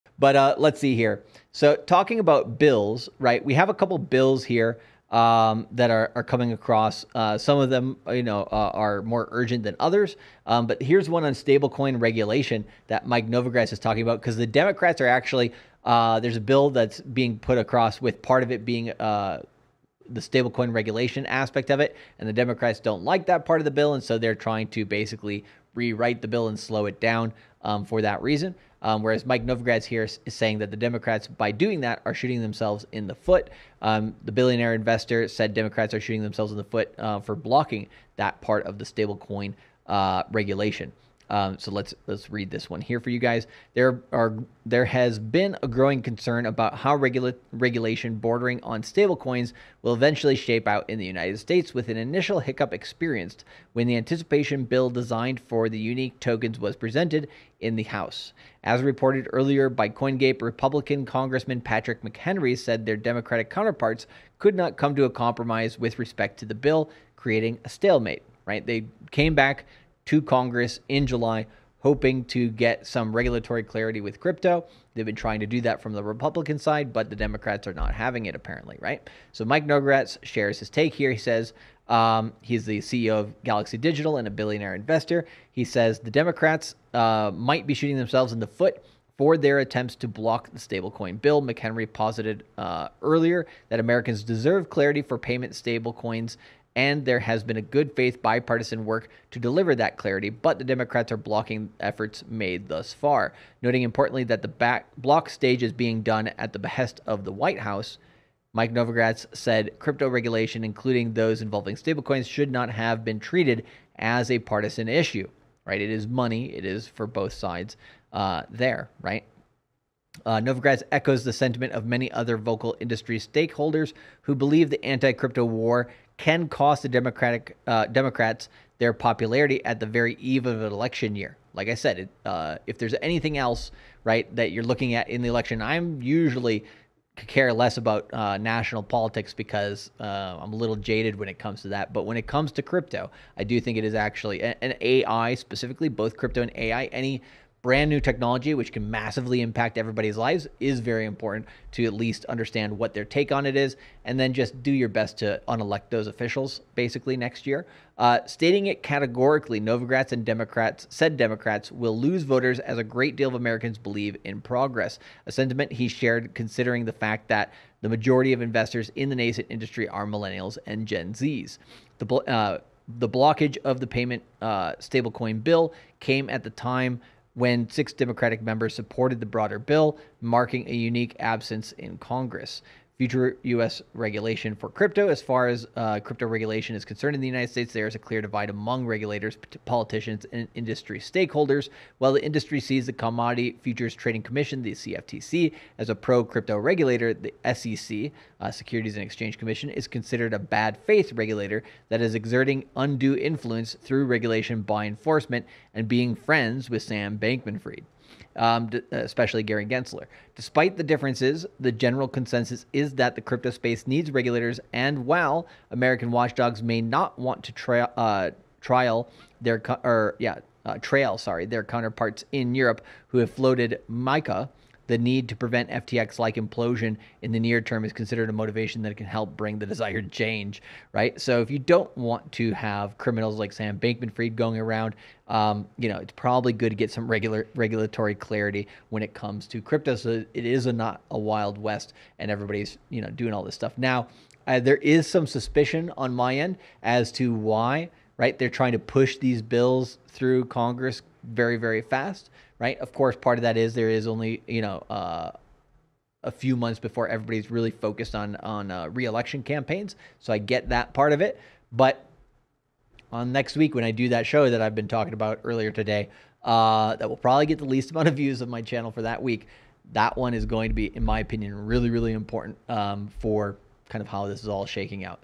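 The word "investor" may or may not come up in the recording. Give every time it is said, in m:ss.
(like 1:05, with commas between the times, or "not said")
0:34, 1:24, 2:48.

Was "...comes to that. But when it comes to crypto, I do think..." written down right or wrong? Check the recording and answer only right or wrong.
right.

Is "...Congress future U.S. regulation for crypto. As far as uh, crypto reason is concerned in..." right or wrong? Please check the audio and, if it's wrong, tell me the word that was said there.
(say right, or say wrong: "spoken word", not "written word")
wrong: "regulation", not "reason".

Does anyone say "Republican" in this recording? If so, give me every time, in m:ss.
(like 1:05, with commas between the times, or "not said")
1:00, 1:16.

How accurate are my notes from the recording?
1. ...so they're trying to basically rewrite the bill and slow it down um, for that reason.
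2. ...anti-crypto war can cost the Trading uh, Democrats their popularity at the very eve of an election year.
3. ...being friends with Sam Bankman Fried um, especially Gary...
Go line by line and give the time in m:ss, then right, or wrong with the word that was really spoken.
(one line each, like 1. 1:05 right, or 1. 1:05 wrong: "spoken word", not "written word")
1. 0:24 right
2. 2:04 wrong: "Democratic", not "Trading"
3. 3:25 right.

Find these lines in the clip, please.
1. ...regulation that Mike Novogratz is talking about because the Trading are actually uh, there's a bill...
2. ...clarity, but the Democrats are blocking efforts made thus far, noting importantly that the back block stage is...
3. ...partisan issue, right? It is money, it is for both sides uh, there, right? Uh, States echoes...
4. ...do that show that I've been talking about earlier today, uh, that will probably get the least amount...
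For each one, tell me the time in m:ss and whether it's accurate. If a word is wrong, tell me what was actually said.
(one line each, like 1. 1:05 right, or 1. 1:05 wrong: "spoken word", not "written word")
1. 0:11 wrong: "Democrats", not "Trading"
2. 1:39 right
3. 1:54 wrong: "Novogratz", not "States"
4. 4:23 right.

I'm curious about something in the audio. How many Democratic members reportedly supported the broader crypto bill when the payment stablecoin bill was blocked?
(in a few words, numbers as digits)
6.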